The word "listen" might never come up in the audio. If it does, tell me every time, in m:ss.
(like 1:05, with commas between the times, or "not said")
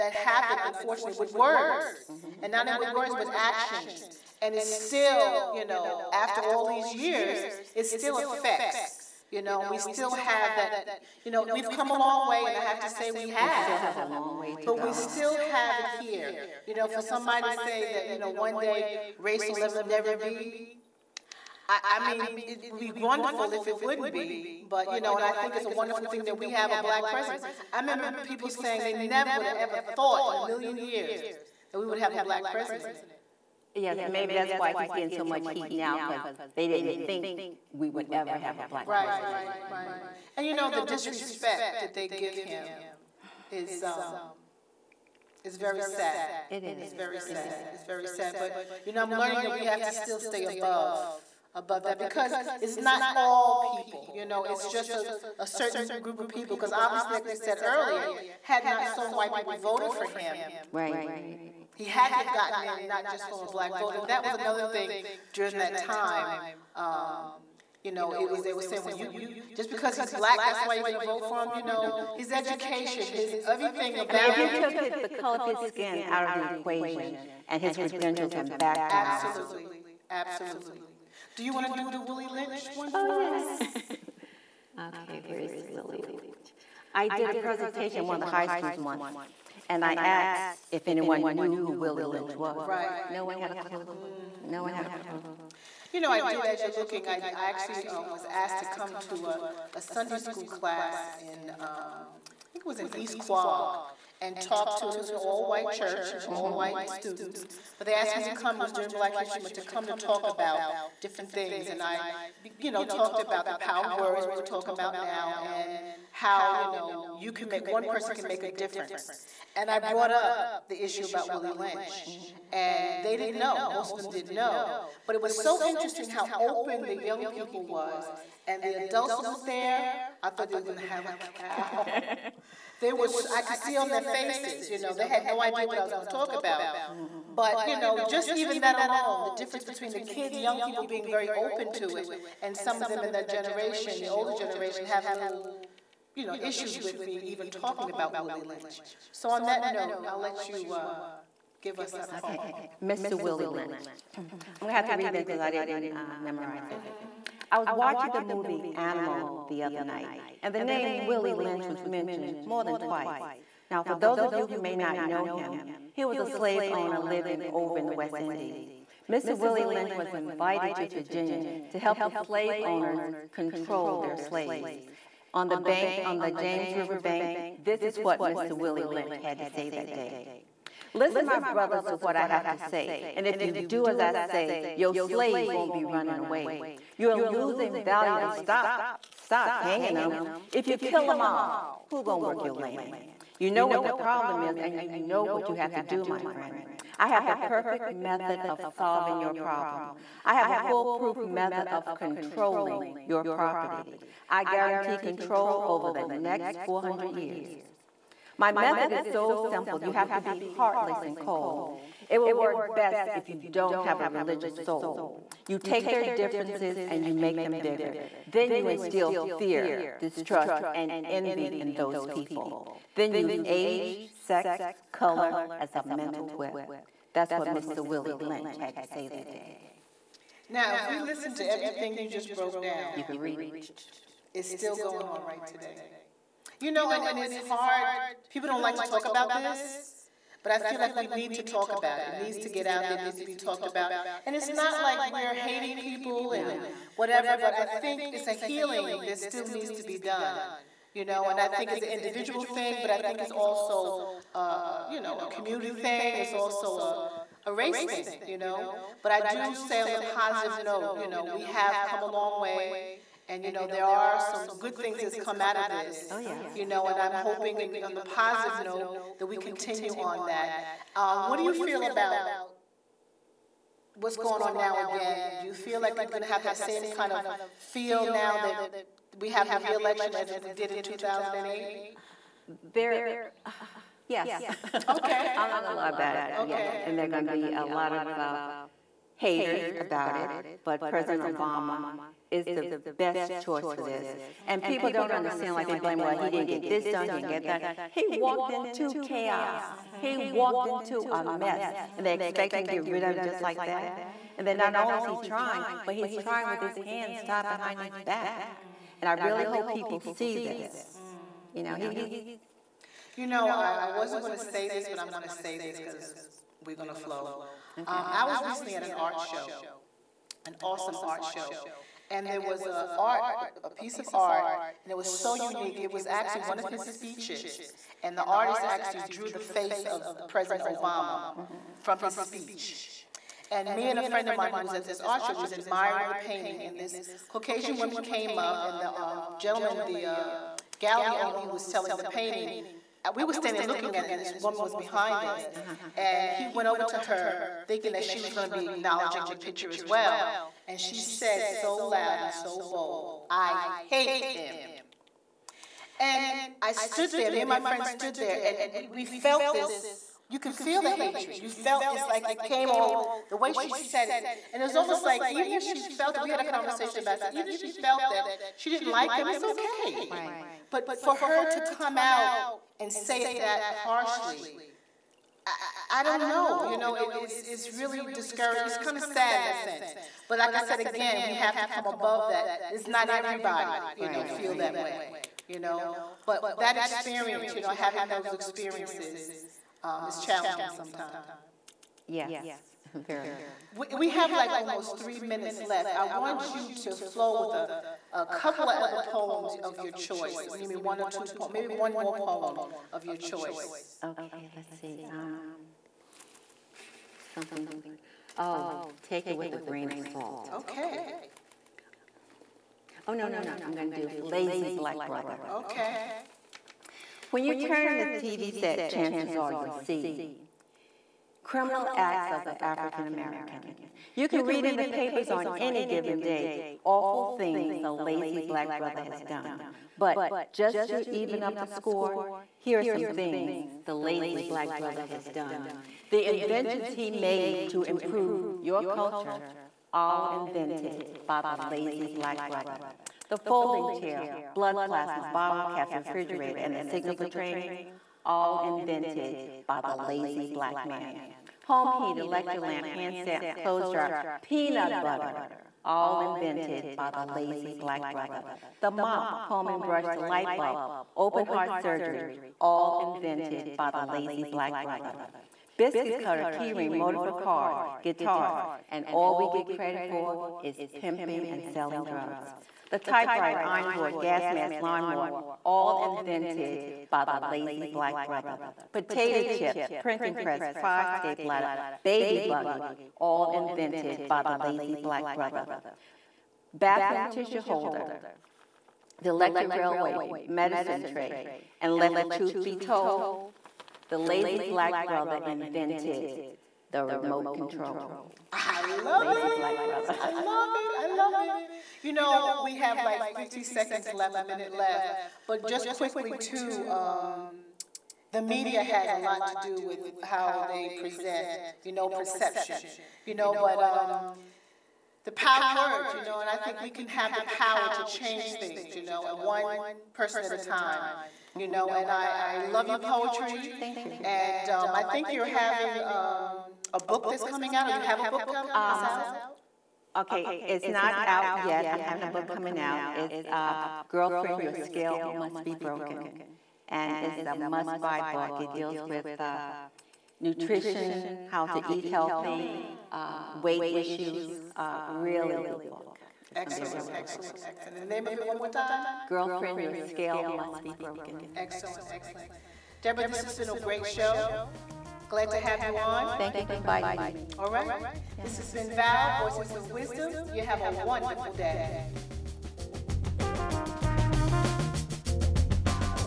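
3:00, 3:50.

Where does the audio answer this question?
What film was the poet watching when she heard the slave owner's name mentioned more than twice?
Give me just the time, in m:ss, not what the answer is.
2:38.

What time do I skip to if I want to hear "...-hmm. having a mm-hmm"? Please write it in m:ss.
8:52.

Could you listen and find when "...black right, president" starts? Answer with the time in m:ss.
0:38.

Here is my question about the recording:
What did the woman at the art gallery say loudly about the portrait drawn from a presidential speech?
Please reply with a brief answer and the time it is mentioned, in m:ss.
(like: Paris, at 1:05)
I hate him, at 5:53.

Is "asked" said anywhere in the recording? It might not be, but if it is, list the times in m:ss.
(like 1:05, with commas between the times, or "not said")
1:29, 1:38, 1:47.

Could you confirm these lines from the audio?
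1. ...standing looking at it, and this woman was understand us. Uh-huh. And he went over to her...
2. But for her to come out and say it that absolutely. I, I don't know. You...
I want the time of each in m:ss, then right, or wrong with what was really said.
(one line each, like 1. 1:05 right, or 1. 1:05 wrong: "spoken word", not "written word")
1. 5:43 wrong: "behind", not "understand"
2. 6:10 wrong: "harshly", not "absolutely".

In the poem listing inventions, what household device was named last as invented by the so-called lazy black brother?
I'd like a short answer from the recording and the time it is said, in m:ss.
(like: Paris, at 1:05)
remote control, at 8:17.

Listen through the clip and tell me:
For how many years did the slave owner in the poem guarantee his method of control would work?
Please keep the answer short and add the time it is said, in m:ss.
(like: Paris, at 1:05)
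400 years, at 3:26.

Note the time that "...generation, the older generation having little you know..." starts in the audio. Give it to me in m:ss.
2:23.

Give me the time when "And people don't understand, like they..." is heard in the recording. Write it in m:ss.
4:54.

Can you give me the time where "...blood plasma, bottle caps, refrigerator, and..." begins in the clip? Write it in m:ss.
7:24.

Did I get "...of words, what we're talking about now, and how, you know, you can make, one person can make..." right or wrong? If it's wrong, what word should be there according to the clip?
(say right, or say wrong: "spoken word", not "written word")
right.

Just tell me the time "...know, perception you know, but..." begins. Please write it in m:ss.
8:31.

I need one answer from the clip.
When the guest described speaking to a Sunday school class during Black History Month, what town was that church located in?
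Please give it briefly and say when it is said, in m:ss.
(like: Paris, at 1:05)
East Quogue, at 1:42.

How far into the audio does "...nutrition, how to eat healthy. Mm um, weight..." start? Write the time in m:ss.
9:00.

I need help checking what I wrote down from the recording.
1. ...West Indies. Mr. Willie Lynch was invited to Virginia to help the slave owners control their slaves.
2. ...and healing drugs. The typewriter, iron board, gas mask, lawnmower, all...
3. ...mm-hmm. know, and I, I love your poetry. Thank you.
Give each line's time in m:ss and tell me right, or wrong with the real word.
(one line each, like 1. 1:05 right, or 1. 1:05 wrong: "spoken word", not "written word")
1. 2:47 right
2. 7:51 wrong: "selling", not "healing"
3. 8:41 right.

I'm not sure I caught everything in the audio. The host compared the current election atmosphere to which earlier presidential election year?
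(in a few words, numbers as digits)
2008.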